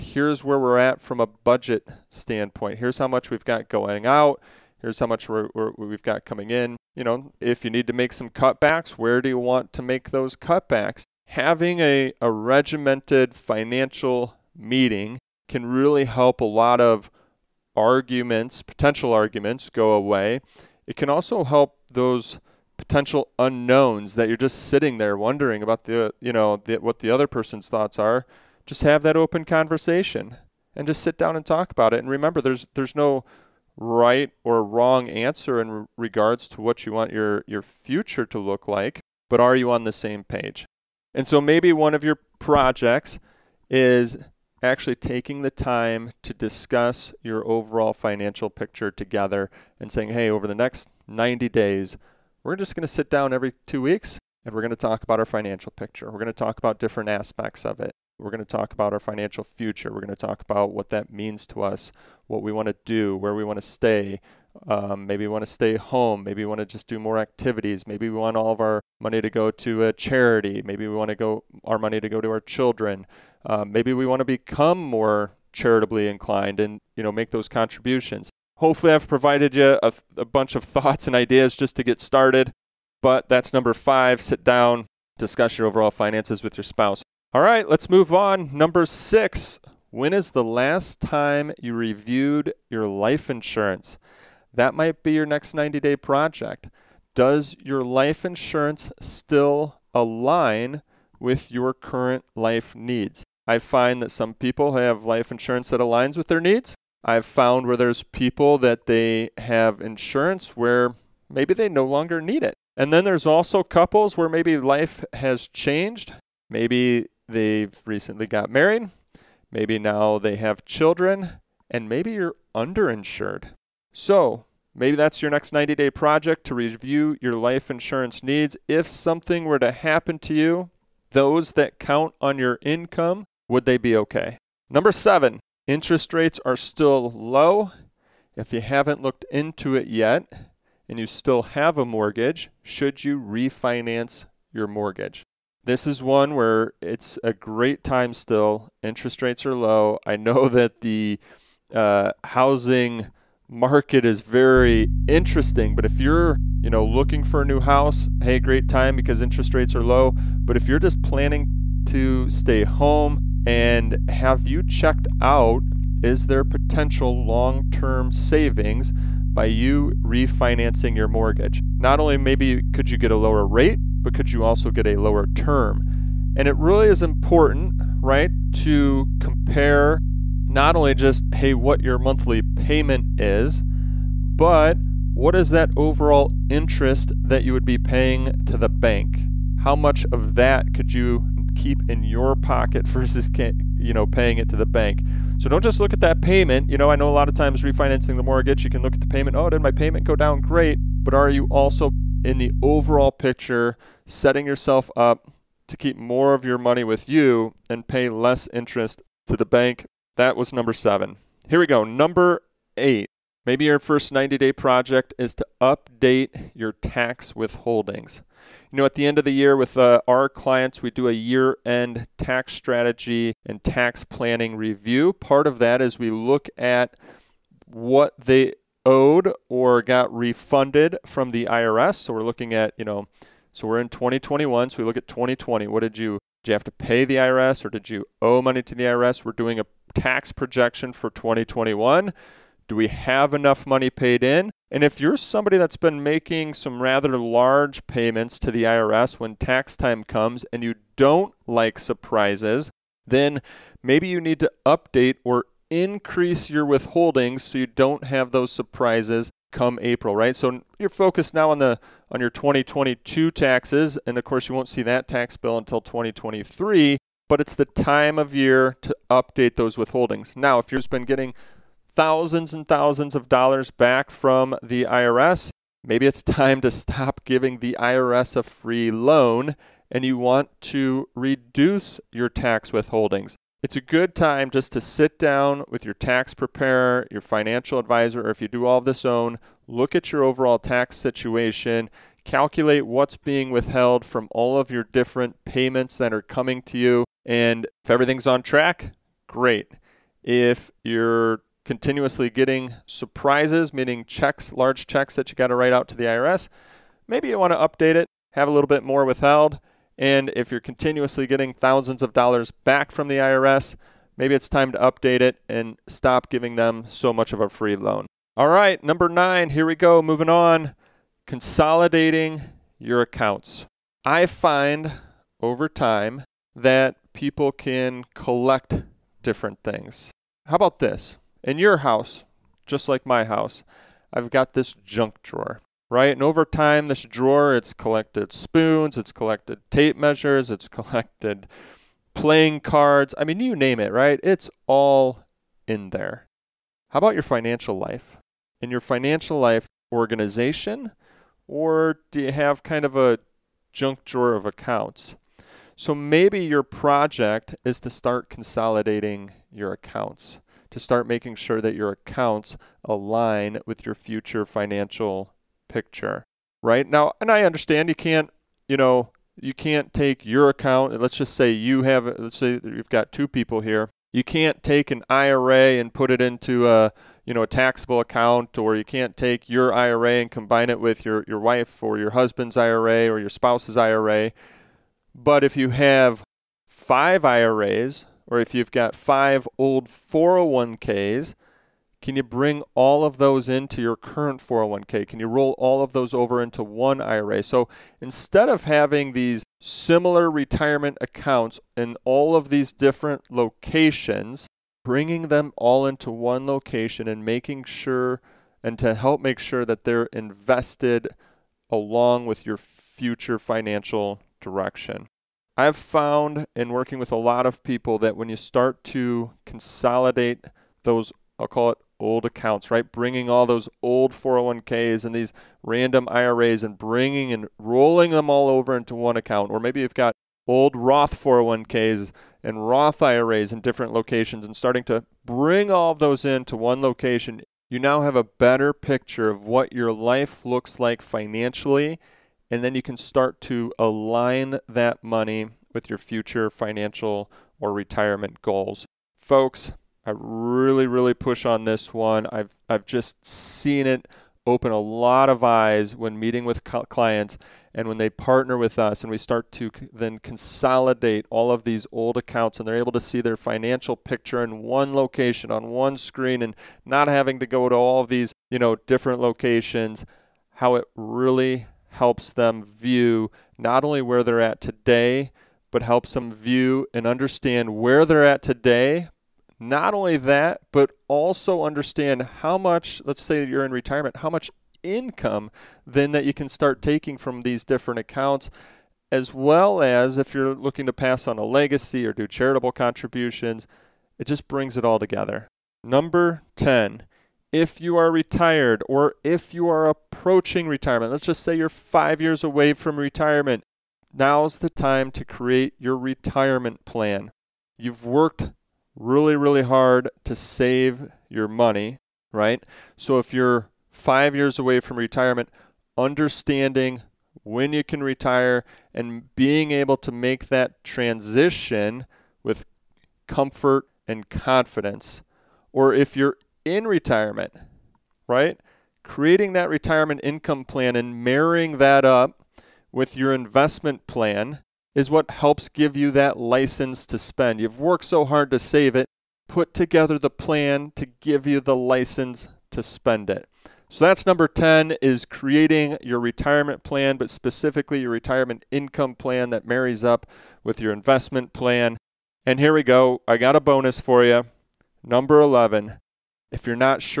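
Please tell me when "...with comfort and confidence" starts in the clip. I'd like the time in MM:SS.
08:42.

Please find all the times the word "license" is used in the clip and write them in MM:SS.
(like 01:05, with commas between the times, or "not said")
08:56, 09:01.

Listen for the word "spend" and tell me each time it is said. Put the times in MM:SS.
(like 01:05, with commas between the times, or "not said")
08:57, 09:02.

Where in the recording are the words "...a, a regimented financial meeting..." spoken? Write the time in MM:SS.
00:11.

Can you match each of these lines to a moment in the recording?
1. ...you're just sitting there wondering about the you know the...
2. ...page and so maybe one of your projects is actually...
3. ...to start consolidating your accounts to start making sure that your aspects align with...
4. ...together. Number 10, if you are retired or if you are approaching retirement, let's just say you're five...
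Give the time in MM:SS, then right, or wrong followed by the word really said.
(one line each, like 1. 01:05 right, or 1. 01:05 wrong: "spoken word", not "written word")
1. 00:24 right
2. 00:40 right
3. 05:57 wrong: "accounts", not "aspects"
4. 08:14 right.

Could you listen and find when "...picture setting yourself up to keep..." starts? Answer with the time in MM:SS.
03:23.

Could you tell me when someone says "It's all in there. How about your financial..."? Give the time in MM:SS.
05:44.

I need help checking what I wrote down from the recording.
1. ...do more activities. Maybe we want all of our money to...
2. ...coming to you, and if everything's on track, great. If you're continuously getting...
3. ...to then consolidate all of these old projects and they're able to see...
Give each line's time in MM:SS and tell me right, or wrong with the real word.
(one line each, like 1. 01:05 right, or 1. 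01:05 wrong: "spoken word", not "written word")
1. 01:06 right
2. 04:56 right
3. 07:39 wrong: "accounts", not "projects".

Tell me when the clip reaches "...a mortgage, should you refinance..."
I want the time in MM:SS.
02:21.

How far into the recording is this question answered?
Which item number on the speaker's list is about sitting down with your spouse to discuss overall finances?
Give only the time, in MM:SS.
01:23.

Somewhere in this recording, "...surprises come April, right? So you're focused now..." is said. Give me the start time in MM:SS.
04:18.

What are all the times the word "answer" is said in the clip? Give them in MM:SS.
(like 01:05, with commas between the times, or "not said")
00:35.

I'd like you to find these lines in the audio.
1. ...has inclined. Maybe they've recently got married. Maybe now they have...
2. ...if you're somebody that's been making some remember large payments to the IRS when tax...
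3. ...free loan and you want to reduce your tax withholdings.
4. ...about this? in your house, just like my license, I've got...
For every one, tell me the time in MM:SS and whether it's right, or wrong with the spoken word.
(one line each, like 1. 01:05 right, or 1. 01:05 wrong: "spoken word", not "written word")
1. 01:55 wrong: "changed", not "inclined"
2. 04:04 wrong: "rather", not "remember"
3. 04:38 right
4. 05:30 wrong: "house", not "license".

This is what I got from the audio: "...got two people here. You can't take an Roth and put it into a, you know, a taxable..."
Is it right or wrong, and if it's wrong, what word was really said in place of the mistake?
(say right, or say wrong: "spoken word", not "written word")
wrong: "IRA", not "Roth".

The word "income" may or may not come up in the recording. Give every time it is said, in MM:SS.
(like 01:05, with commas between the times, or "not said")
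02:12, 08:04, 08:50, 09:08.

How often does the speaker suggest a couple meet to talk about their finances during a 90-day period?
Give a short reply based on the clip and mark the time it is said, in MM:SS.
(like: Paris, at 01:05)
Every two weeks, at 00:53.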